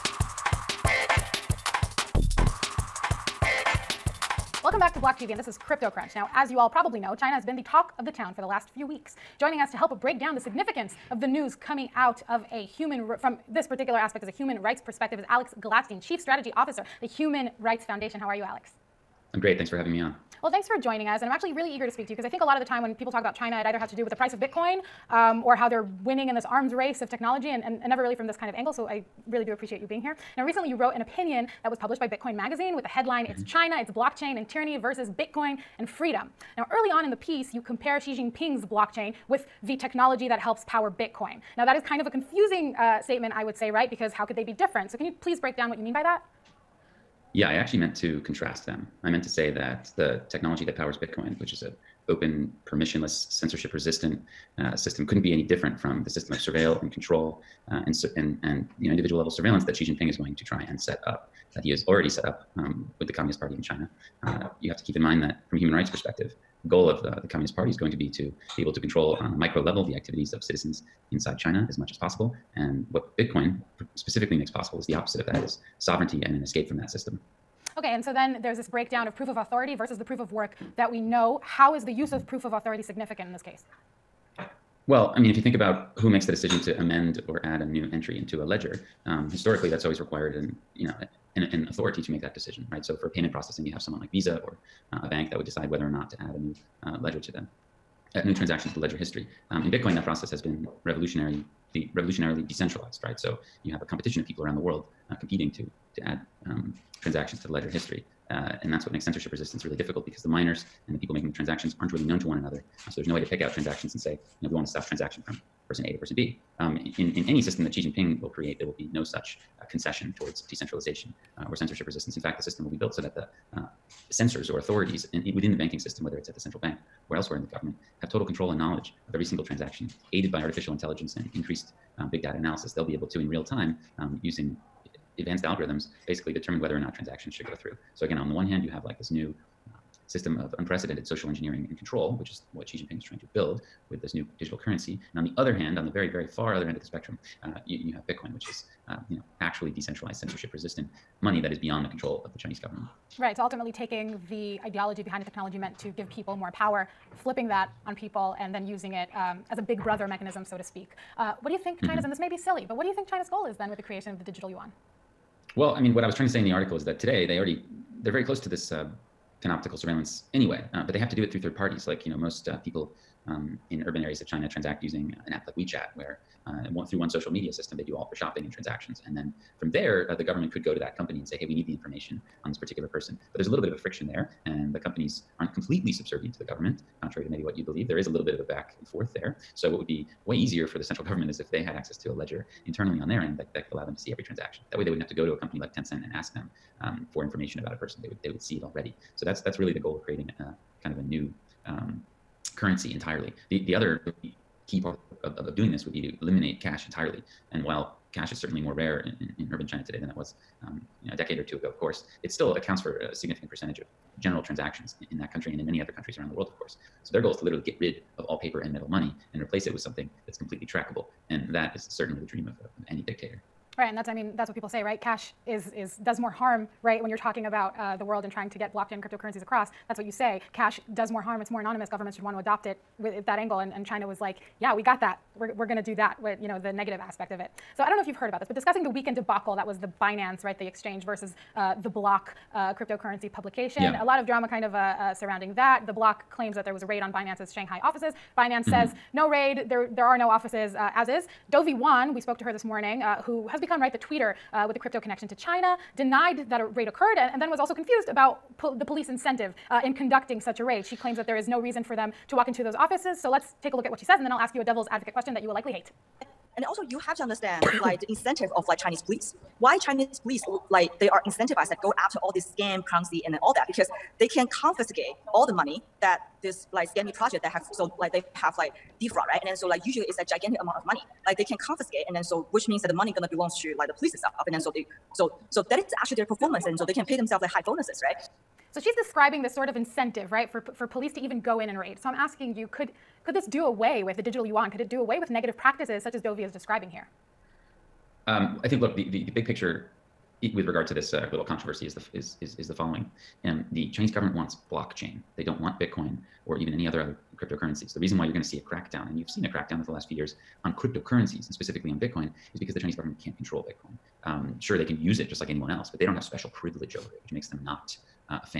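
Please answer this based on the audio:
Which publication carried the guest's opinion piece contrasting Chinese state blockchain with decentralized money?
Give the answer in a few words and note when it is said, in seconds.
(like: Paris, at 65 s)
Bitcoin Magazine, at 32 s.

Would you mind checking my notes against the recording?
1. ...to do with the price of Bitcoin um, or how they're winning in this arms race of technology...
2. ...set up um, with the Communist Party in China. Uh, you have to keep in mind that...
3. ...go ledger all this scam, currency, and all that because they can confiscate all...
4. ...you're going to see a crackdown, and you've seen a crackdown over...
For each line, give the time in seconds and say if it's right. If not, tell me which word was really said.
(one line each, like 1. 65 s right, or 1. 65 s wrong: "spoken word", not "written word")
1. 23 s right
2. 62 s right
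3. 271 s wrong: "after", not "ledger"
4. 308 s right.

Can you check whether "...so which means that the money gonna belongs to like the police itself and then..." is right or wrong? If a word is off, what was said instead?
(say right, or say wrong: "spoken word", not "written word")
right.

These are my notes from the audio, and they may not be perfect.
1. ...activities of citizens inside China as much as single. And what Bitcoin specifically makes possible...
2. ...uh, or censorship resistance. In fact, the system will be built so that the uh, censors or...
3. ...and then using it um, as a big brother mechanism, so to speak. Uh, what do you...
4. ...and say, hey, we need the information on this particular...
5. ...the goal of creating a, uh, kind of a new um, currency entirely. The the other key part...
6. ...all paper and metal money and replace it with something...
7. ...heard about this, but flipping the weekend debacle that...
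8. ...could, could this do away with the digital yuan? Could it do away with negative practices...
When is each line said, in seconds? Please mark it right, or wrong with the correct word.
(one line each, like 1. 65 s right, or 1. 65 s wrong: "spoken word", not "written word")
1. 69 s wrong: "possible", not "single"
2. 121 s right
3. 158 s right
4. 181 s right
5. 199 s right
6. 218 s right
7. 238 s wrong: "discussing", not "flipping"
8. 292 s right.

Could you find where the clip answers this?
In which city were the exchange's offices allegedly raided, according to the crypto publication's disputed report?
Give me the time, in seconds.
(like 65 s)
247 s.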